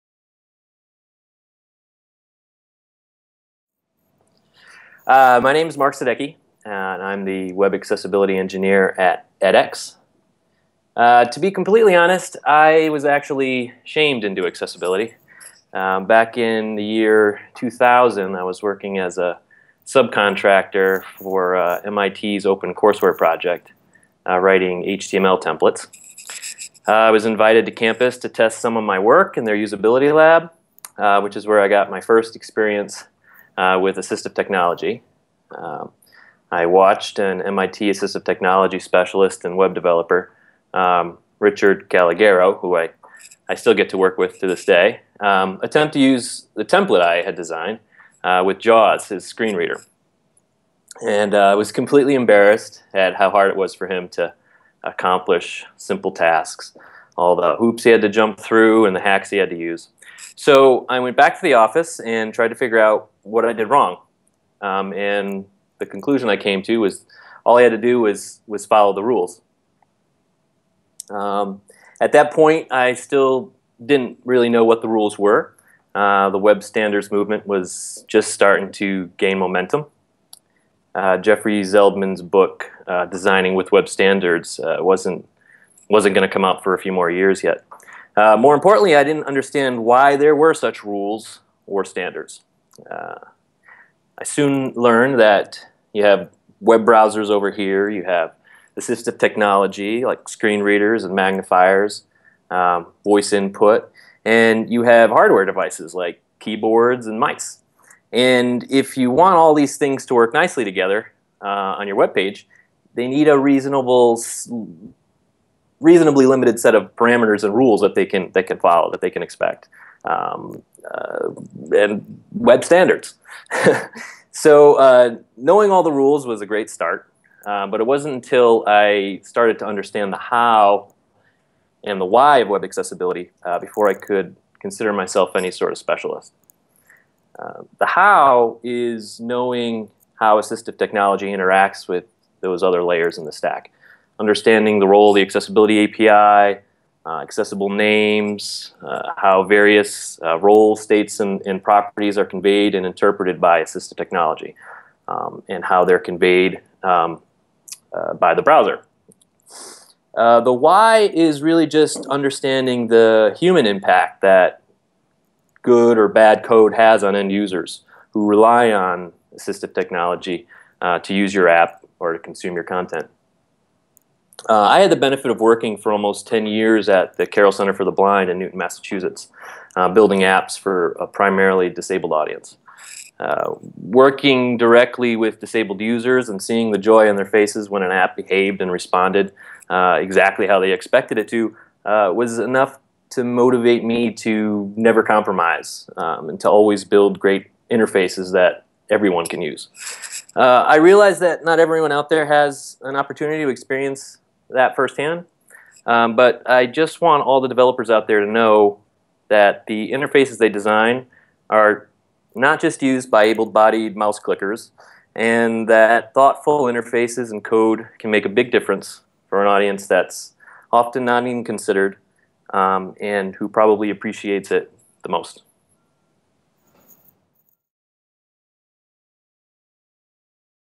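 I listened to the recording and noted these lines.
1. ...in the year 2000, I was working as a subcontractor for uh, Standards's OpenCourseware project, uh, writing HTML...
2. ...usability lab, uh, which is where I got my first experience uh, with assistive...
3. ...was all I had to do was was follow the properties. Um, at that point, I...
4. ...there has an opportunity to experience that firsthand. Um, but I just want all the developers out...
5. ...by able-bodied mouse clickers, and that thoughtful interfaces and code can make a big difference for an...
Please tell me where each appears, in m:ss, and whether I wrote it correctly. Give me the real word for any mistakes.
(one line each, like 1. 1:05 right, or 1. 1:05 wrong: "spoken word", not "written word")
1. 0:16 wrong: "MIT", not "Standards"
2. 0:29 right
3. 1:06 wrong: "rules", not "properties"
4. 3:22 right
5. 3:33 right.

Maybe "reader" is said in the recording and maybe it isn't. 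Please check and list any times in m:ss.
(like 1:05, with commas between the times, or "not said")
0:49, 1:40.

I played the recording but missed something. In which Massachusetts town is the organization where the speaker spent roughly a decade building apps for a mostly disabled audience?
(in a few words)
Newton.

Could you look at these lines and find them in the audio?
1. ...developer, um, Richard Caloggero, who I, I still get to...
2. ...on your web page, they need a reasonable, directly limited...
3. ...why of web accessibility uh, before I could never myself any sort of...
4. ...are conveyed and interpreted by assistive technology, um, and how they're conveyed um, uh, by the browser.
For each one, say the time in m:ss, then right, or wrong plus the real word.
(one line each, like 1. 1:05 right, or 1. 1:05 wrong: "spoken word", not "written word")
1. 0:39 right
2. 1:51 wrong: "reasonably", not "directly"
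3. 2:12 wrong: "consider", not "never"
4. 2:32 right.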